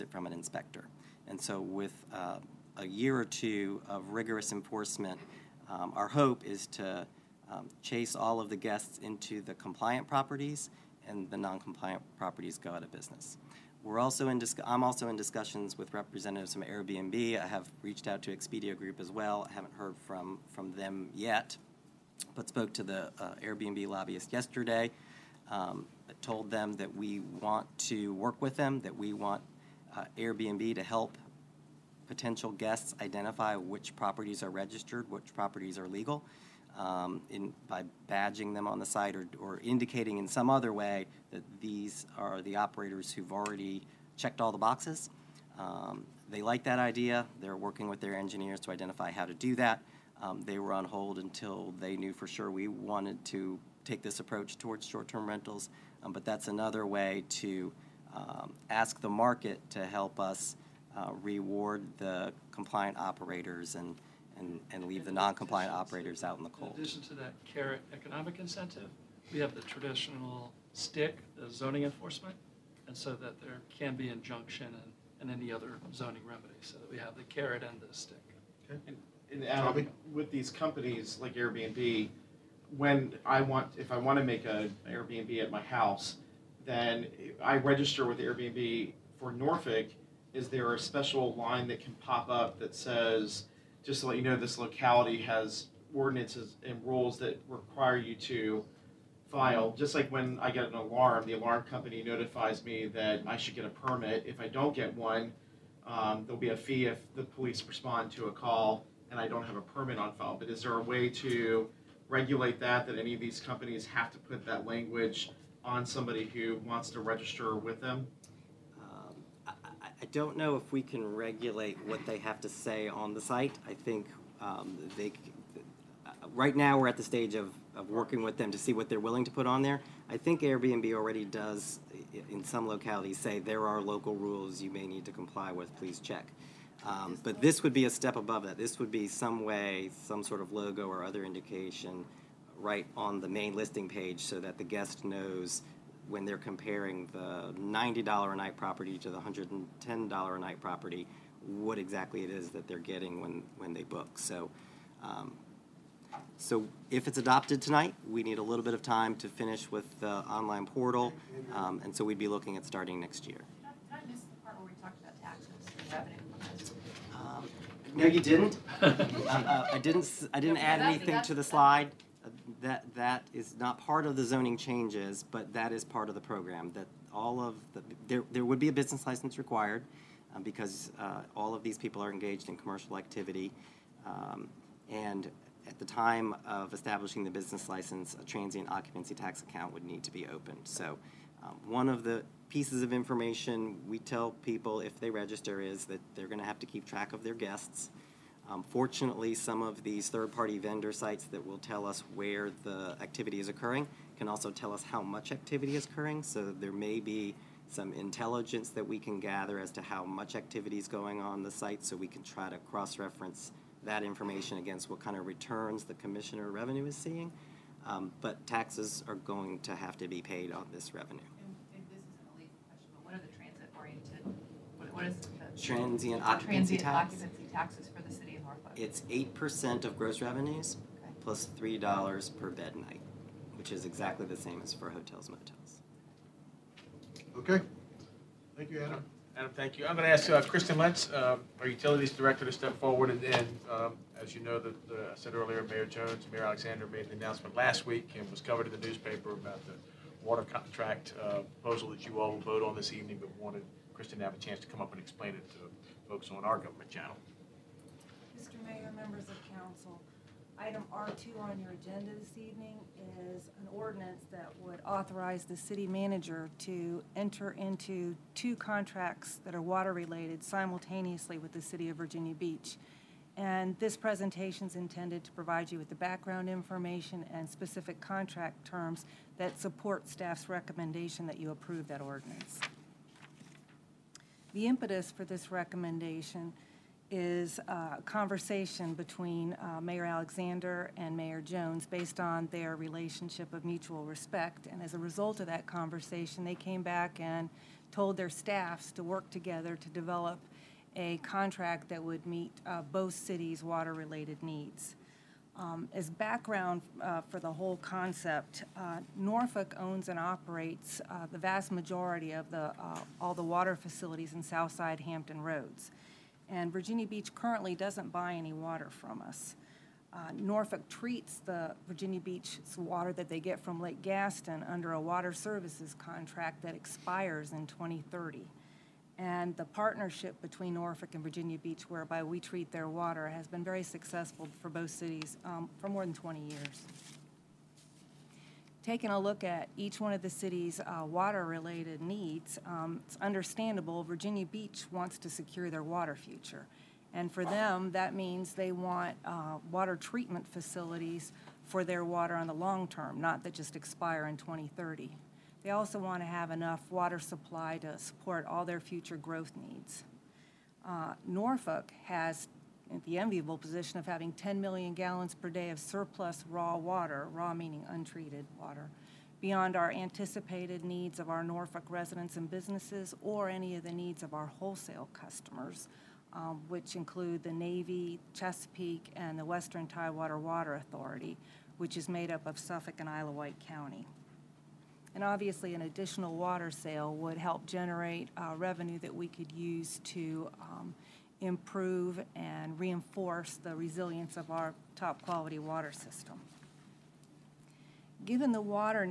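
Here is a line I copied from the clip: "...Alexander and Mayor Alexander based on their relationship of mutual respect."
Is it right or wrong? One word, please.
wrong.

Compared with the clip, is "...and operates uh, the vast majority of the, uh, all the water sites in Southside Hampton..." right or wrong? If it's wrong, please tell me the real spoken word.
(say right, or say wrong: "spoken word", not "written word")
wrong: "facilities", not "sites".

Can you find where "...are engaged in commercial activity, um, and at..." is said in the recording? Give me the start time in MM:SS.
03:02.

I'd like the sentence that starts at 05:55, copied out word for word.
They also want to have enough water supply to support all their future growth needs.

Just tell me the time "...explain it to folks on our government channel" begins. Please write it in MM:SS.
04:15.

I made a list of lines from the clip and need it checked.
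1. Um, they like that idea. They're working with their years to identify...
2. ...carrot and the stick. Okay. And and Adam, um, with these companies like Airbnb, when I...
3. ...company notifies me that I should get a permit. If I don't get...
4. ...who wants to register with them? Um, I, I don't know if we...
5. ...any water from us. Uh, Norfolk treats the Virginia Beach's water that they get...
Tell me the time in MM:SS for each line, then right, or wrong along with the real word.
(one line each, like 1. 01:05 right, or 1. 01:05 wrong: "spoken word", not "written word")
1. 00:45 wrong: "engineers", not "years"
2. 01:17 right
3. 01:41 right
4. 01:56 right
5. 05:18 right.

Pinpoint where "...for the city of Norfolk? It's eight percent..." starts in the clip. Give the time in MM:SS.
03:47.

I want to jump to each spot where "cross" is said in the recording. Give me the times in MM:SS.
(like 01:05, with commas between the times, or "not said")
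03:32.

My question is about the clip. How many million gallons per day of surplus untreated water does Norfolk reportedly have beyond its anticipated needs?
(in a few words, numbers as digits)
10.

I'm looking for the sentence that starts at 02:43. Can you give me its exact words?
I, I miss the part where we talked about taxes and revenue?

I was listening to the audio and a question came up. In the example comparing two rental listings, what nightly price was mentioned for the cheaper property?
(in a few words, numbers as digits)
$90.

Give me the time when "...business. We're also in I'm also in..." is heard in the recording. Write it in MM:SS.
00:12.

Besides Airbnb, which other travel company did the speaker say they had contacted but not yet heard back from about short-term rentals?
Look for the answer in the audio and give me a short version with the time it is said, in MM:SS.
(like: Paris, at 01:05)
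Expedia Group, at 00:18.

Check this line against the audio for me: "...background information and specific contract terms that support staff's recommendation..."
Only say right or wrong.
right.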